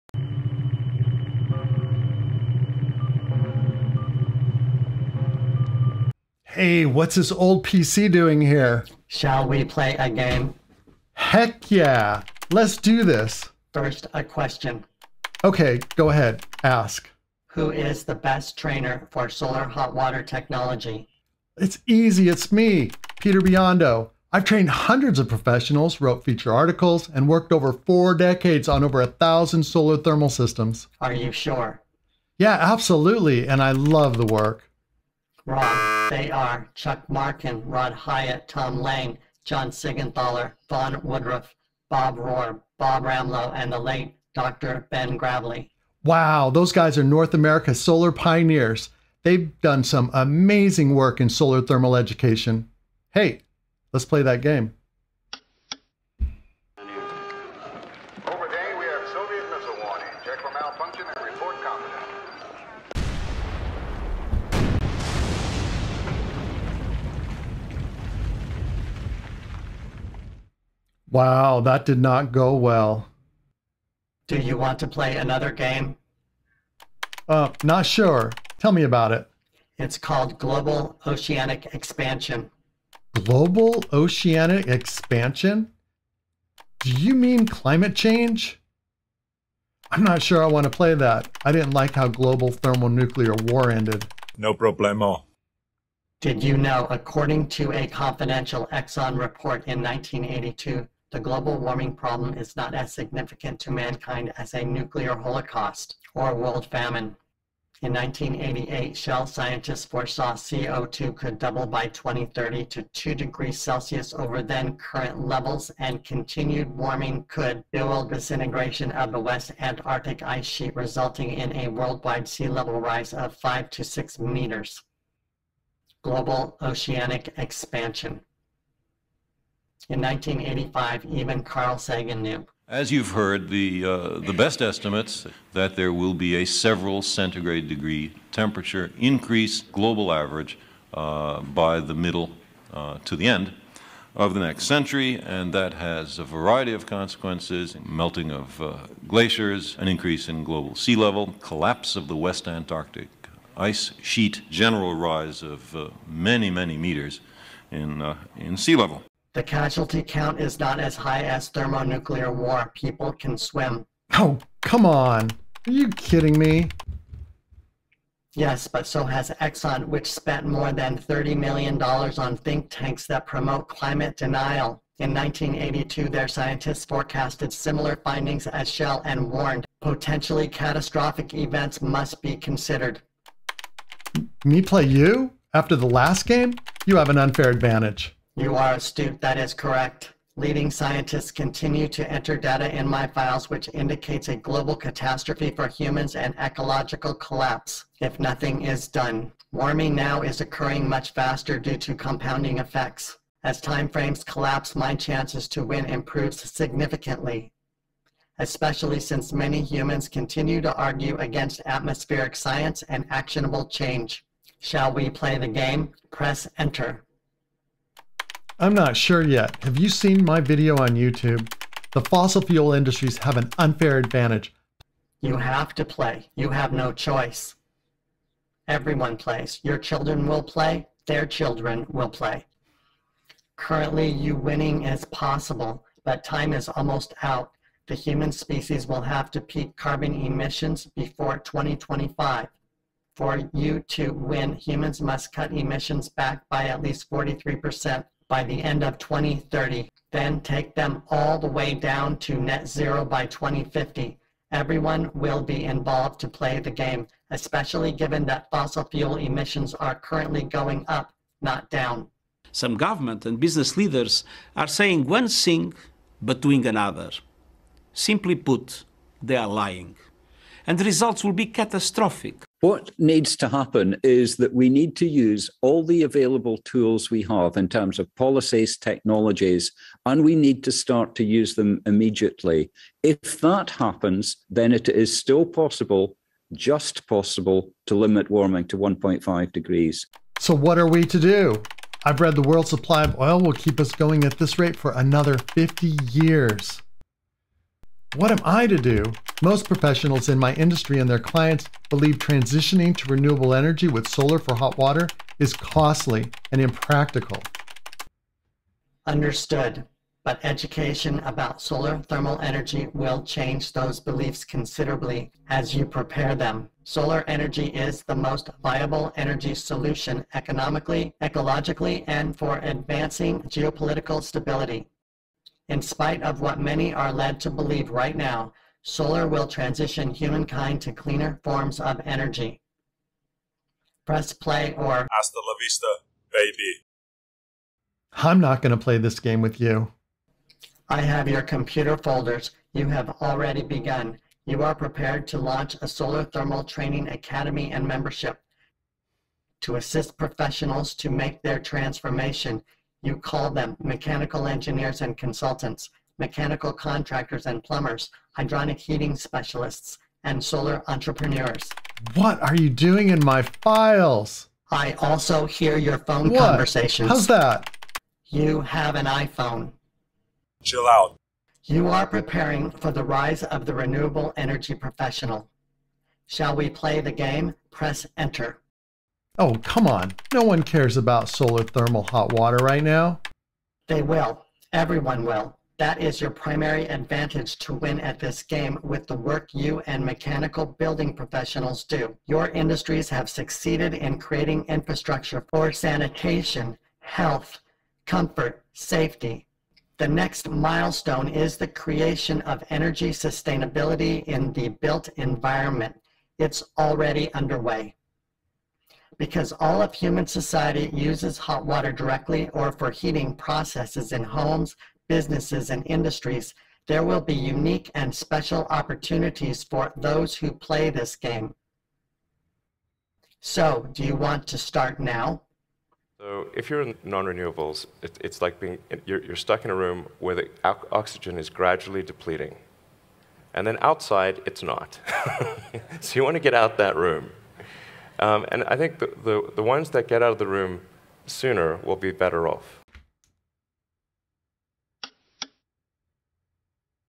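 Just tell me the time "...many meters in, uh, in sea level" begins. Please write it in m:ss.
2:36.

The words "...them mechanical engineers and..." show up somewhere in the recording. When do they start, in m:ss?
5:53.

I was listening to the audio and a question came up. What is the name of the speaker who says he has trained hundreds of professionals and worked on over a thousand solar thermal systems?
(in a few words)
Peter Biondo.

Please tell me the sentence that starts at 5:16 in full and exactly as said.
Solar energy is the most viable energy solution economically, ecologically, and for advancing geopolitical stability.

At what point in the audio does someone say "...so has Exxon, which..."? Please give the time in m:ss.
2:48.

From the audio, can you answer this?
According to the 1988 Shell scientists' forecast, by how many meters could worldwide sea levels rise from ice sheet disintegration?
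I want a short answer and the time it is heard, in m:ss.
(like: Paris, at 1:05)
5 to 6 meters, at 2:03.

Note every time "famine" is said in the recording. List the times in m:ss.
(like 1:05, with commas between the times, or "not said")
1:46.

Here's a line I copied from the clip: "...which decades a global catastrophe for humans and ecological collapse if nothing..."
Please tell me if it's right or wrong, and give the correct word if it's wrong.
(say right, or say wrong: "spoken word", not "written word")
wrong: "indicates", not "decades".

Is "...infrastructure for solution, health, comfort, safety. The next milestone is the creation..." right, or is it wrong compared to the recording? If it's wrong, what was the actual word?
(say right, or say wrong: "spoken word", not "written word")
wrong: "sanitation", not "solution".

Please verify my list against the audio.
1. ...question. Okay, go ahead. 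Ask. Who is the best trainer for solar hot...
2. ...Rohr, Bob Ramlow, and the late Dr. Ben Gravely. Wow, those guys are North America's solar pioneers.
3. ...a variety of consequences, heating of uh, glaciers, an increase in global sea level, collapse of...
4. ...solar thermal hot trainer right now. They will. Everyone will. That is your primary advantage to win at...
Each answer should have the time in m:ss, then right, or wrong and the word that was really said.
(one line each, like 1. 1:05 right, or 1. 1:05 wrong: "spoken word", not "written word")
1. 0:14 right
2. 0:42 right
3. 2:26 wrong: "melting", not "heating"
4. 6:21 wrong: "water", not "trainer".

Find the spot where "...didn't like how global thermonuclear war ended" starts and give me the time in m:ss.
1:31.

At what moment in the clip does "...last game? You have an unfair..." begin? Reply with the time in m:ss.
3:05.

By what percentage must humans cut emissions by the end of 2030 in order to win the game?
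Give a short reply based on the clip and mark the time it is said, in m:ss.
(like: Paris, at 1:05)
43%, at 4:07.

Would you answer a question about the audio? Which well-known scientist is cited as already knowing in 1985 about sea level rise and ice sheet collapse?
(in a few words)
Carl Sagan.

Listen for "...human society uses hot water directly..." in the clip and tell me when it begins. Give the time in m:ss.
6:49.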